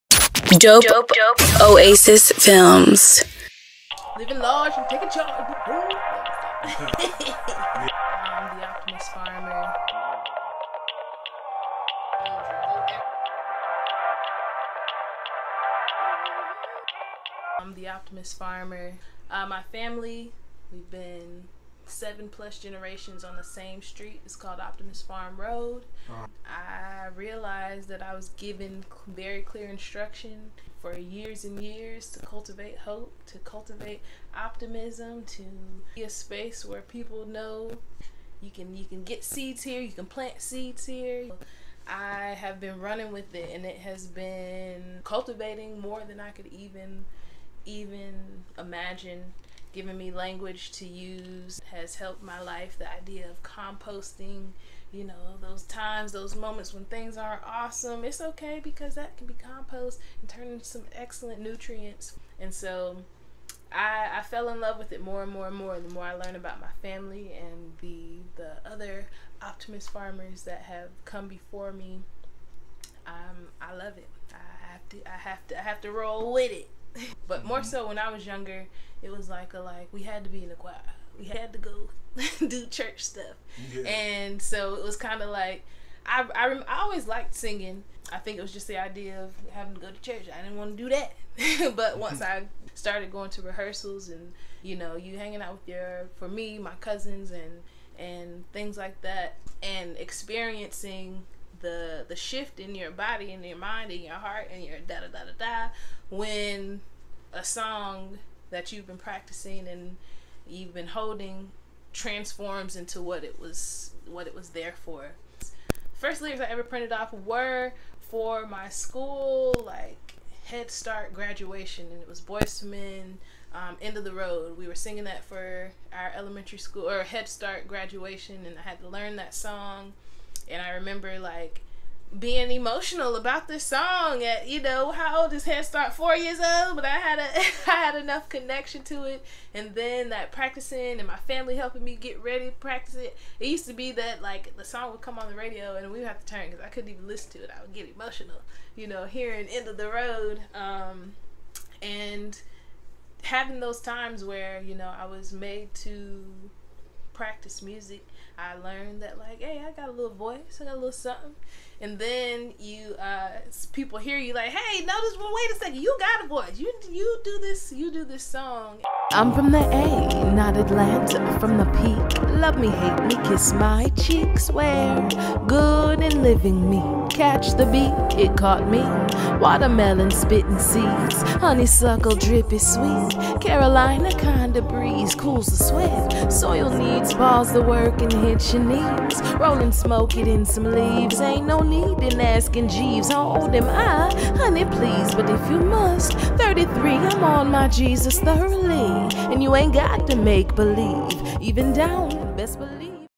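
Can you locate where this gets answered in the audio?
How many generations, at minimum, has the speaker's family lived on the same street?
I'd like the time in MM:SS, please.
00:21.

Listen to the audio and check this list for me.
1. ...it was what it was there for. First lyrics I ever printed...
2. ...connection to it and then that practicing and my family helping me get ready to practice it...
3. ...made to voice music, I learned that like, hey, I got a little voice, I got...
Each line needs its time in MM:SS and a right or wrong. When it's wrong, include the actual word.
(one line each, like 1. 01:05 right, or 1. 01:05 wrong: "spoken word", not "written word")
1. 01:53 right
2. 02:18 right
3. 02:35 wrong: "practice", not "voice".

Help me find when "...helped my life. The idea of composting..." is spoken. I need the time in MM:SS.
00:51.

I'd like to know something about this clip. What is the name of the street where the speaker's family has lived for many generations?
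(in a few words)
Optimus Farm Road.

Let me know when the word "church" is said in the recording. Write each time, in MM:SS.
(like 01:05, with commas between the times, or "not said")
01:22, 01:30.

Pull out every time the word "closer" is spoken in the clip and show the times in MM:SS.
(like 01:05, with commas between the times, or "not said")
not said.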